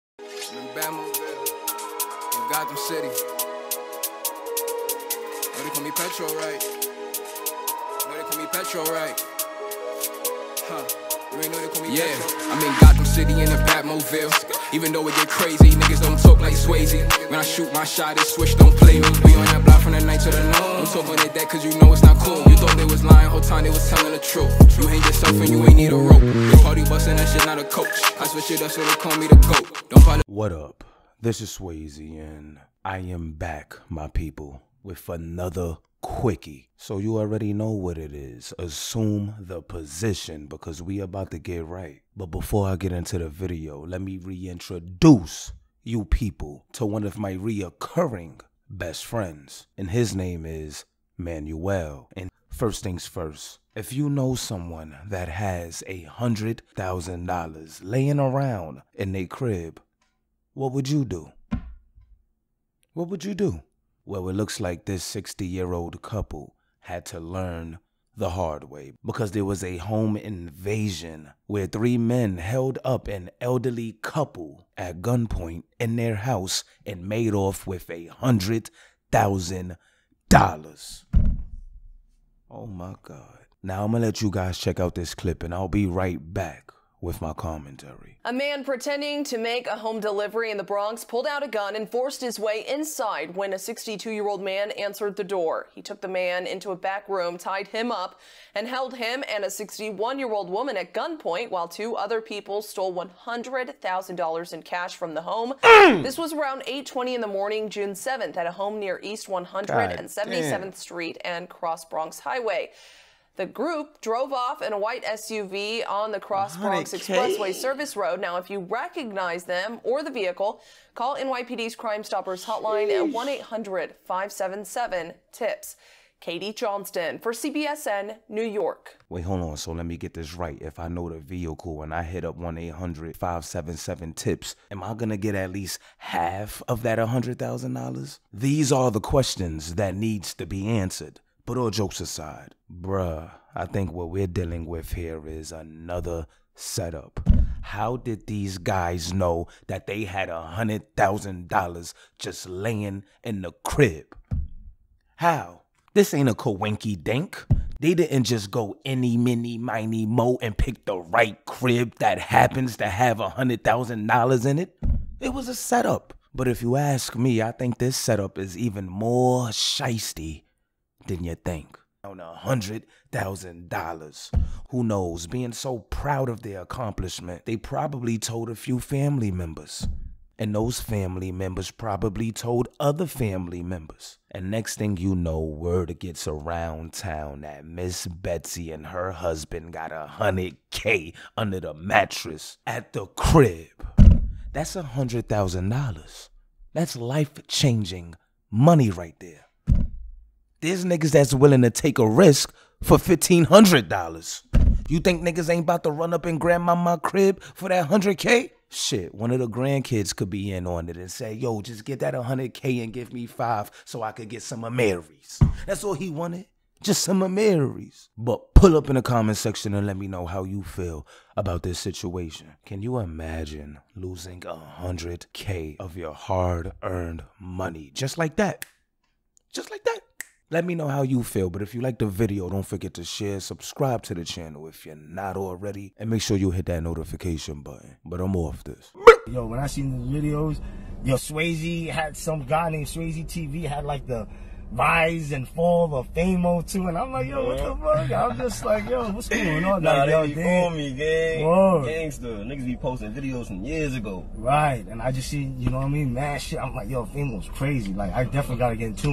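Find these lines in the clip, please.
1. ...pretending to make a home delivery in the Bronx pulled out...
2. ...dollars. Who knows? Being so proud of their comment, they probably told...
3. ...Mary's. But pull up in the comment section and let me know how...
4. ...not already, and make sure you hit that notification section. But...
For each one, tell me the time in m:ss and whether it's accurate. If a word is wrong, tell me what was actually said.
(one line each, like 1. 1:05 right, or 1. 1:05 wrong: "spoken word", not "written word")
1. 1:28 right
2. 2:53 wrong: "accomplishment", not "comment"
3. 3:37 right
4. 3:54 wrong: "button", not "section".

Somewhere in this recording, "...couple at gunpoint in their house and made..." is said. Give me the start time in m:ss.
1:14.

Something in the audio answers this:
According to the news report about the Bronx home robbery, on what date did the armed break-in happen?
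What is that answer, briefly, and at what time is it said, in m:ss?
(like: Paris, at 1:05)
June 7, at 1:47.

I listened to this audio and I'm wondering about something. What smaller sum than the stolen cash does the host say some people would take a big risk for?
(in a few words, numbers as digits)
$1,500.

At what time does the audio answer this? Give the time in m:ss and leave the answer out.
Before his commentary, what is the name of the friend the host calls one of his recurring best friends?
0:51.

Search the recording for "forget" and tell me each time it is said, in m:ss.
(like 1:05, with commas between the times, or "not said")
3:52.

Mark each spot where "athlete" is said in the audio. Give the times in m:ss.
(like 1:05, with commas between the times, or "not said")
not said.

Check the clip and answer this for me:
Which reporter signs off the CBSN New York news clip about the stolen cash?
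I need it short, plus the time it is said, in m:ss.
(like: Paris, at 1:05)
Katie Johnston, at 2:06.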